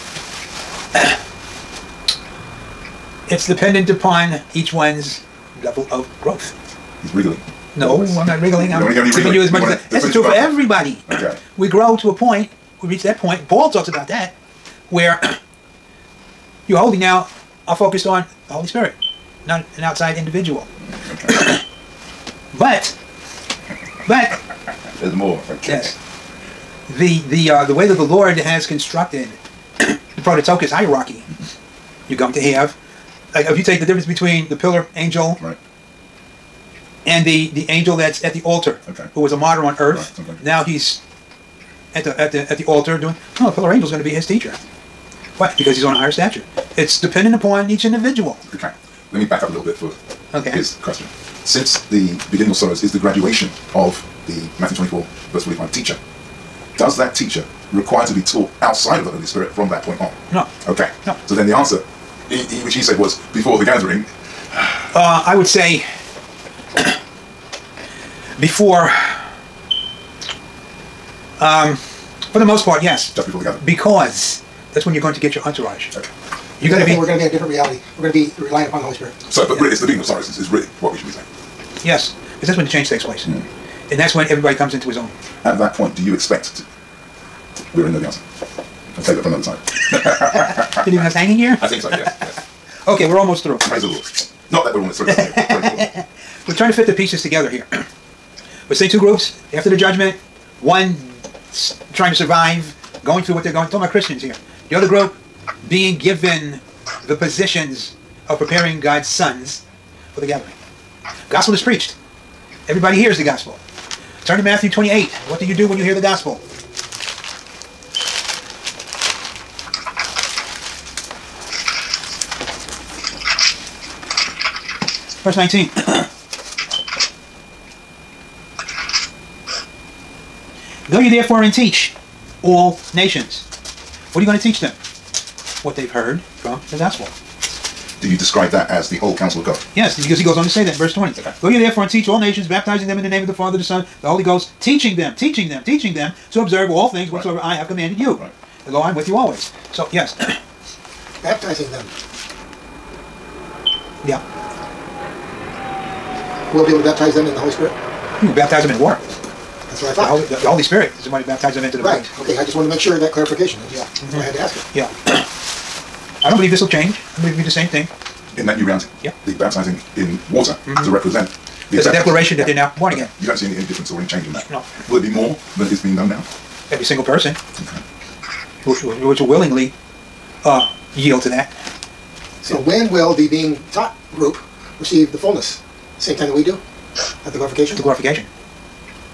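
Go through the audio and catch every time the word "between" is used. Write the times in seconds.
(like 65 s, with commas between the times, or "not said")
34 s.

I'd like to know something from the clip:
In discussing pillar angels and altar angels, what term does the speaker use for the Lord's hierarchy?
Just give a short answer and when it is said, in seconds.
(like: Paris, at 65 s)
Prototokos, at 30 s.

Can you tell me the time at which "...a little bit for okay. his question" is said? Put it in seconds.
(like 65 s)
49 s.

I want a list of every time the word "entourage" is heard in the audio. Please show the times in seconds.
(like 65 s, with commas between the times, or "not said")
75 s.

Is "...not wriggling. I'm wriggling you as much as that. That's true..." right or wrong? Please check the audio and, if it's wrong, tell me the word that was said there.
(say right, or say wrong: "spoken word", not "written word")
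wrong: "giving", not "wriggling".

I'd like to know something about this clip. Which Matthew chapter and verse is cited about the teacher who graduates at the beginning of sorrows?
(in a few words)
Matthew 24:45.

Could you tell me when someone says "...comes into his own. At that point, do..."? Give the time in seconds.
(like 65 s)
84 s.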